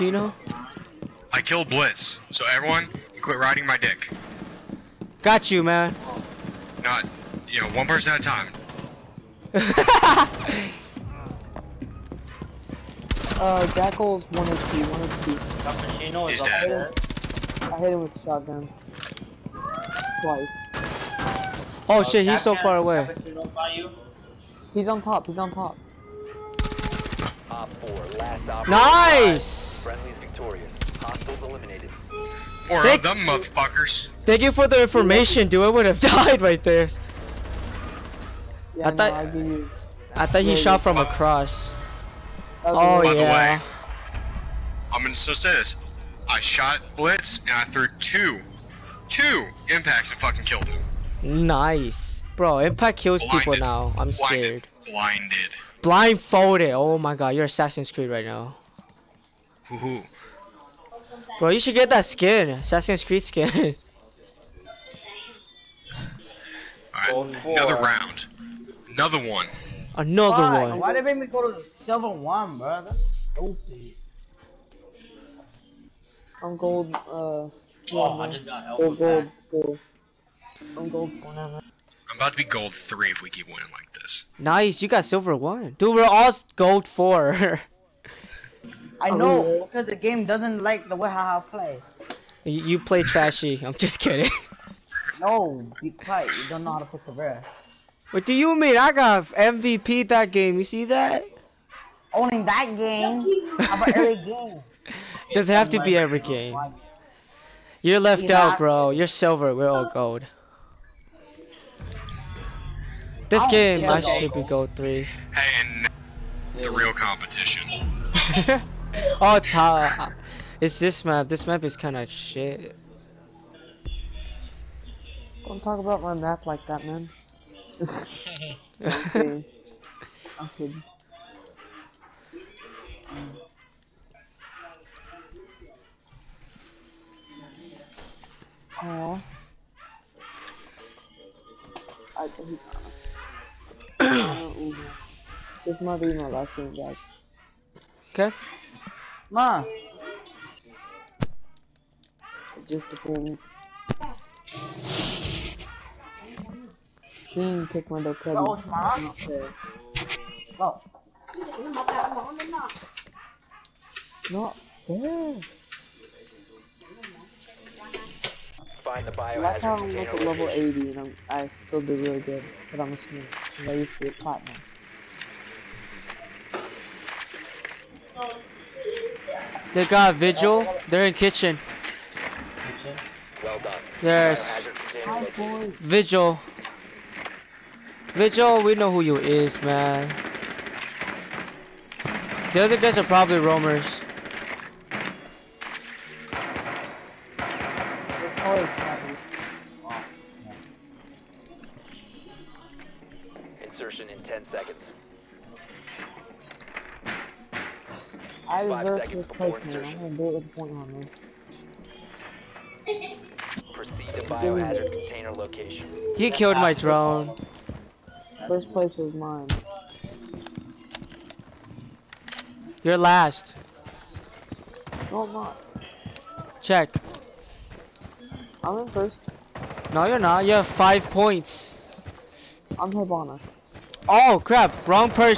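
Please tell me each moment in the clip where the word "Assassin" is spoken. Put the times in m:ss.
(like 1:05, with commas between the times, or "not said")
0:57, 1:02.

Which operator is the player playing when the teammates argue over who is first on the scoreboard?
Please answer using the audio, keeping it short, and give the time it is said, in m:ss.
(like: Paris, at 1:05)
Hibana, at 3:52.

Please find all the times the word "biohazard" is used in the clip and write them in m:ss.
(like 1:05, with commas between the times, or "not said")
2:49, 3:34.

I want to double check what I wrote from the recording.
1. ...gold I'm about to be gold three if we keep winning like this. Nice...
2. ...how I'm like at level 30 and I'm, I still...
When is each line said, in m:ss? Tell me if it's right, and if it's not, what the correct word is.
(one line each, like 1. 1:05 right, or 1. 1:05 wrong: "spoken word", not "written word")
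1. 1:20 right
2. 2:49 wrong: "80", not "30".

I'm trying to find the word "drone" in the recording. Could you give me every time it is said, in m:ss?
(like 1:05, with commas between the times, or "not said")
3:36.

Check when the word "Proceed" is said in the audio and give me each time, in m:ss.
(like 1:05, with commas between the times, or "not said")
3:33.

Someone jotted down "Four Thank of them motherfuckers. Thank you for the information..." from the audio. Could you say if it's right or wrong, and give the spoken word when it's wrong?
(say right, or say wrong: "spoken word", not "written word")
right.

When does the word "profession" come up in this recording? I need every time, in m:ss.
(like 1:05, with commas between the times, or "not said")
not said.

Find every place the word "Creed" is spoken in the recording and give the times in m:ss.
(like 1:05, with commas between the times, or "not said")
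0:57, 1:03.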